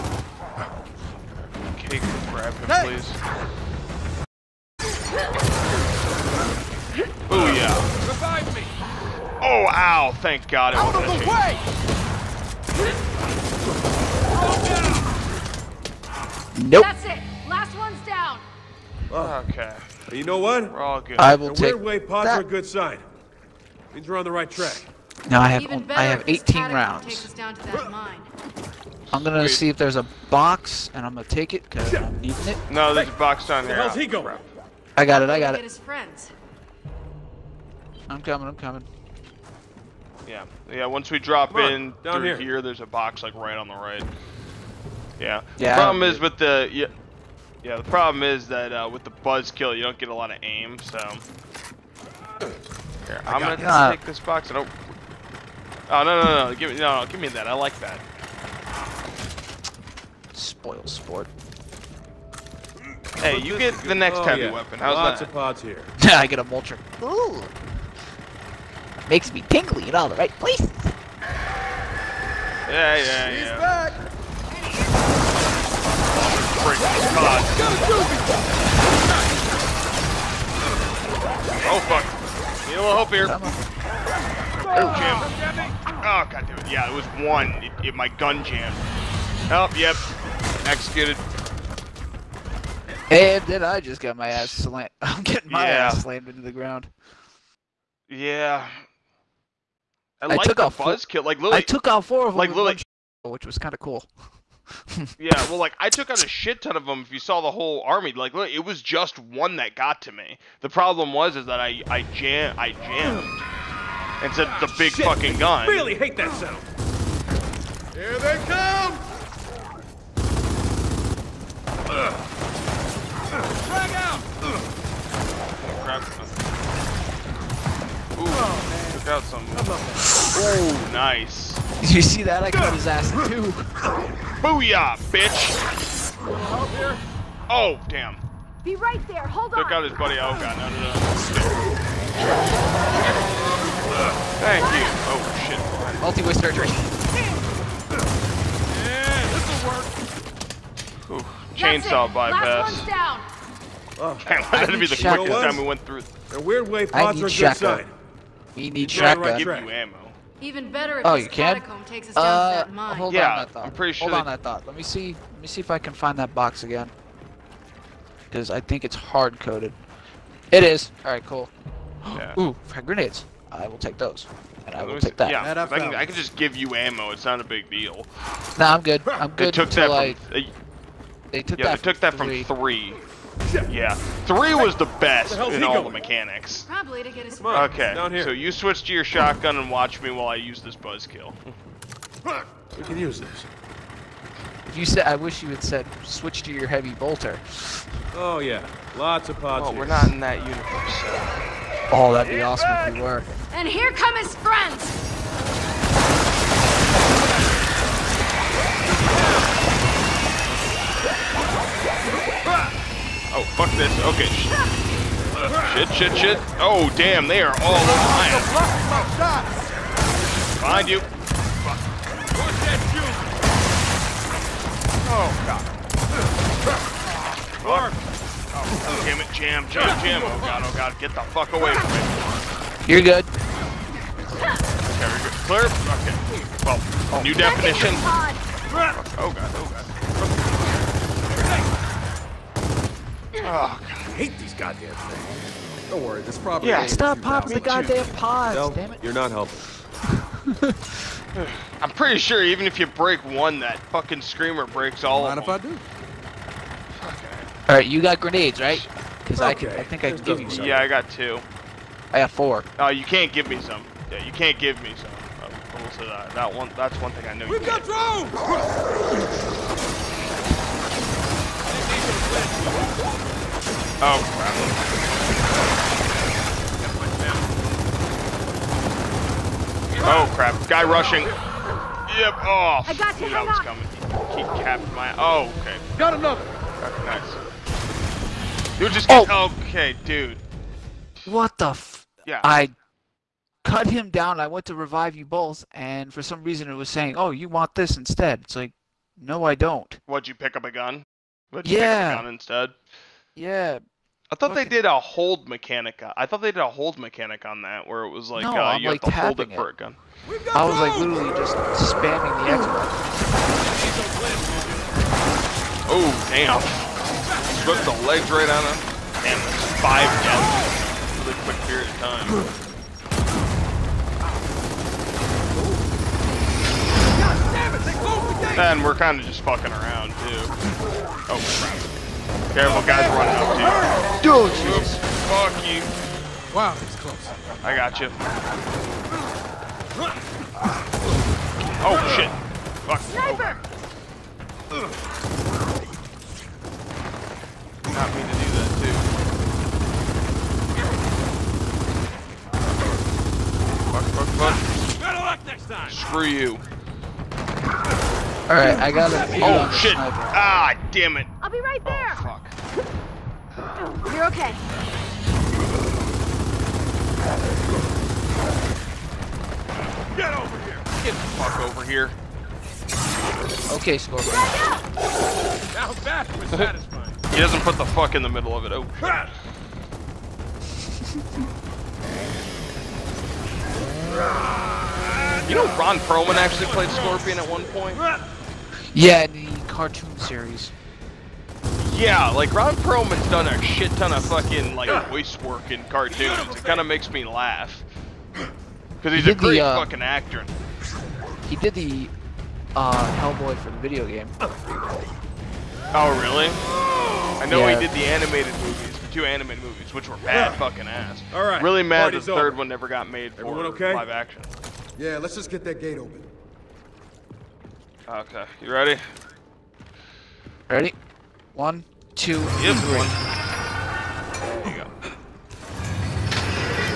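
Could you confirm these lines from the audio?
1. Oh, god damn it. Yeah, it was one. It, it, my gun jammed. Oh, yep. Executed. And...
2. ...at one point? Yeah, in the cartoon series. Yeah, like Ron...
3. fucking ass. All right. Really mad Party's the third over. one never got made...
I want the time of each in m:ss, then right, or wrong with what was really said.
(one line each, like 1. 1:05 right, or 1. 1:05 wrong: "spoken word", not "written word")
1. 1:26 right
2. 6:27 right
3. 6:50 right.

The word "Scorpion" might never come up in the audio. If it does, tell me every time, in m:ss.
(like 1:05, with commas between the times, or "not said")
6:13, 6:26.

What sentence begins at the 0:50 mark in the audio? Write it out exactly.
So here, I'm gonna take this box.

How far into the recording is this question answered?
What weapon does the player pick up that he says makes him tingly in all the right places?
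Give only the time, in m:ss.
1:06.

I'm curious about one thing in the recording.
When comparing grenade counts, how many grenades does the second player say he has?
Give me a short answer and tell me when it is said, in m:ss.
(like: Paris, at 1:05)
4, at 4:22.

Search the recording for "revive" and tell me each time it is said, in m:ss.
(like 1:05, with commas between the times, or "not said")
0:08, 4:54.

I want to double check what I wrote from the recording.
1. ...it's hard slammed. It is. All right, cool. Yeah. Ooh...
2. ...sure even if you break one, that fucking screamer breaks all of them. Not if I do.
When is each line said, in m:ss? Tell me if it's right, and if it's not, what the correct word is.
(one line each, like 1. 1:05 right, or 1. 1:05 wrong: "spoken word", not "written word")
1. 2:48 wrong: "coded", not "slammed"
2. 4:12 right.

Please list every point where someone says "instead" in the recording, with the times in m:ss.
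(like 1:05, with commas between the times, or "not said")
4:57, 5:02.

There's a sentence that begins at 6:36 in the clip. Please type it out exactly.
It kind of makes me laugh because he's he a great the, uh, fucking actor.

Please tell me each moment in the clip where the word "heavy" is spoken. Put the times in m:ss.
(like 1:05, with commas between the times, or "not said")
1:04, 3:16.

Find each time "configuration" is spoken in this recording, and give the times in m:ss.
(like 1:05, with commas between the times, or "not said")
not said.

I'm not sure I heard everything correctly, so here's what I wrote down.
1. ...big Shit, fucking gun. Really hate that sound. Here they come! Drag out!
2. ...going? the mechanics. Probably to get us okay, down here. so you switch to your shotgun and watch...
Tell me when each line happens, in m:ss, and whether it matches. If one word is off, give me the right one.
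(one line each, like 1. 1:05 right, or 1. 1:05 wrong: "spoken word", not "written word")
1. 1:54 right
2. 3:05 right.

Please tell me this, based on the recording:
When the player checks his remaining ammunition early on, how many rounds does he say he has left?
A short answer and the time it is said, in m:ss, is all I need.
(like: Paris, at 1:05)
18, at 0:26.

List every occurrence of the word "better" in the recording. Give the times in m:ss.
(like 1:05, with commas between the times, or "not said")
2:40, 5:55.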